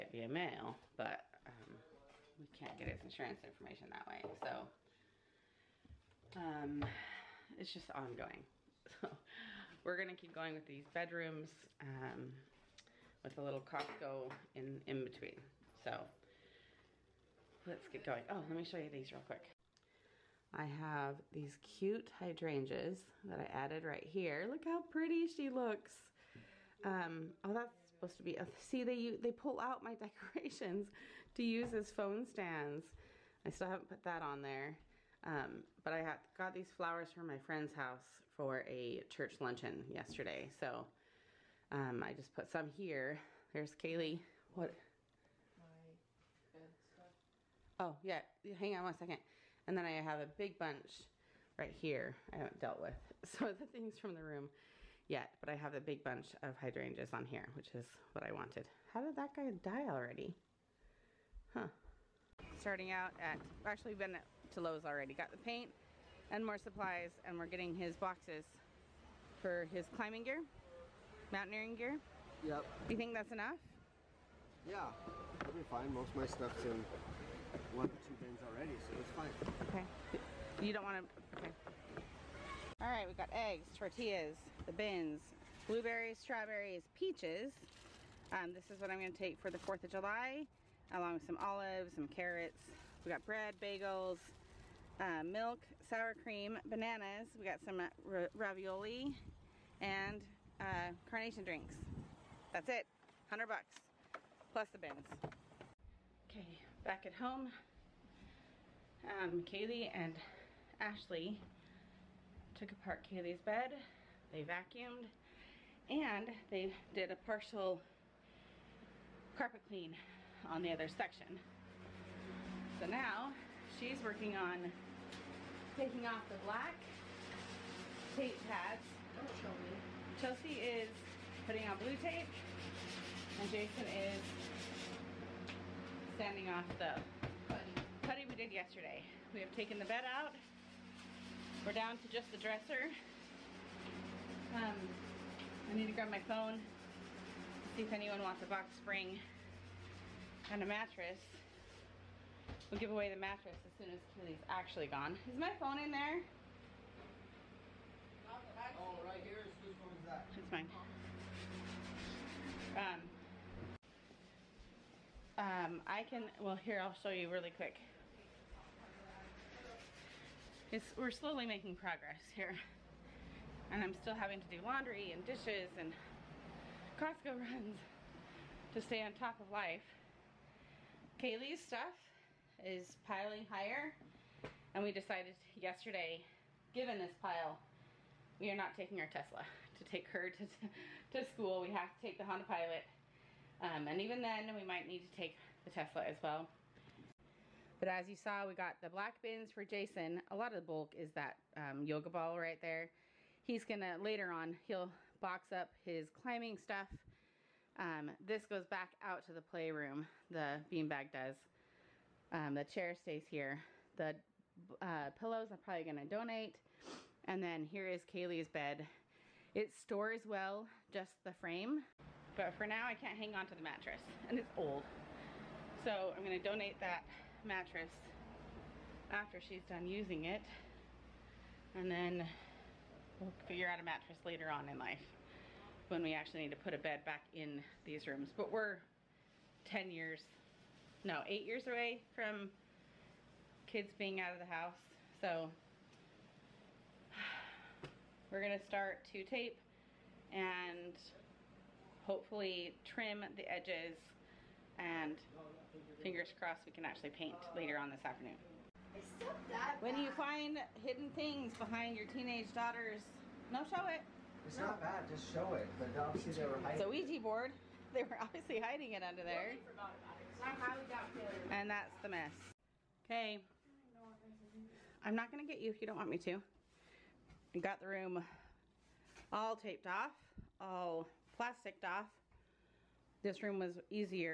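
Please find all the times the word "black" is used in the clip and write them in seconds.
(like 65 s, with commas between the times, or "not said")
126 s, 198 s.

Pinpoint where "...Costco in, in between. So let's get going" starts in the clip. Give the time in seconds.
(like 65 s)
13 s.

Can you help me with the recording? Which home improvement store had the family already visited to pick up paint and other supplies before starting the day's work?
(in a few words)
Lowe's.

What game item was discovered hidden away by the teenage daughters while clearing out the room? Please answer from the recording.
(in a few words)
Ouija board.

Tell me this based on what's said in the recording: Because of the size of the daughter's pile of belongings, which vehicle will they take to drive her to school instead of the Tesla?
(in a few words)
Honda Pilot.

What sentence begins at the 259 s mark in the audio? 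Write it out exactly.
When you find hidden things behind your teenage daughters, no, show it.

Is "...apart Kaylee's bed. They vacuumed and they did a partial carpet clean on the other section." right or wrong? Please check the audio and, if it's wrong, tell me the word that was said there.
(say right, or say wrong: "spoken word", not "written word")
right.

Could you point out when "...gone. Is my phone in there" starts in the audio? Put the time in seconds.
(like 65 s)
154 s.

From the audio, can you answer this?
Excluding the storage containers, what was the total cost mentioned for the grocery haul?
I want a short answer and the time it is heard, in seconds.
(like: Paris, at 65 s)
$100, at 103 s.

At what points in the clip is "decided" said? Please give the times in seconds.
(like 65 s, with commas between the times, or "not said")
184 s.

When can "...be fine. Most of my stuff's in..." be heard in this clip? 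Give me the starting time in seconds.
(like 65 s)
75 s.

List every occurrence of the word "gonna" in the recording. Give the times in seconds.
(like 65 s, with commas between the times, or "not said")
9 s, 88 s, 203 s, 215 s, 226 s, 248 s.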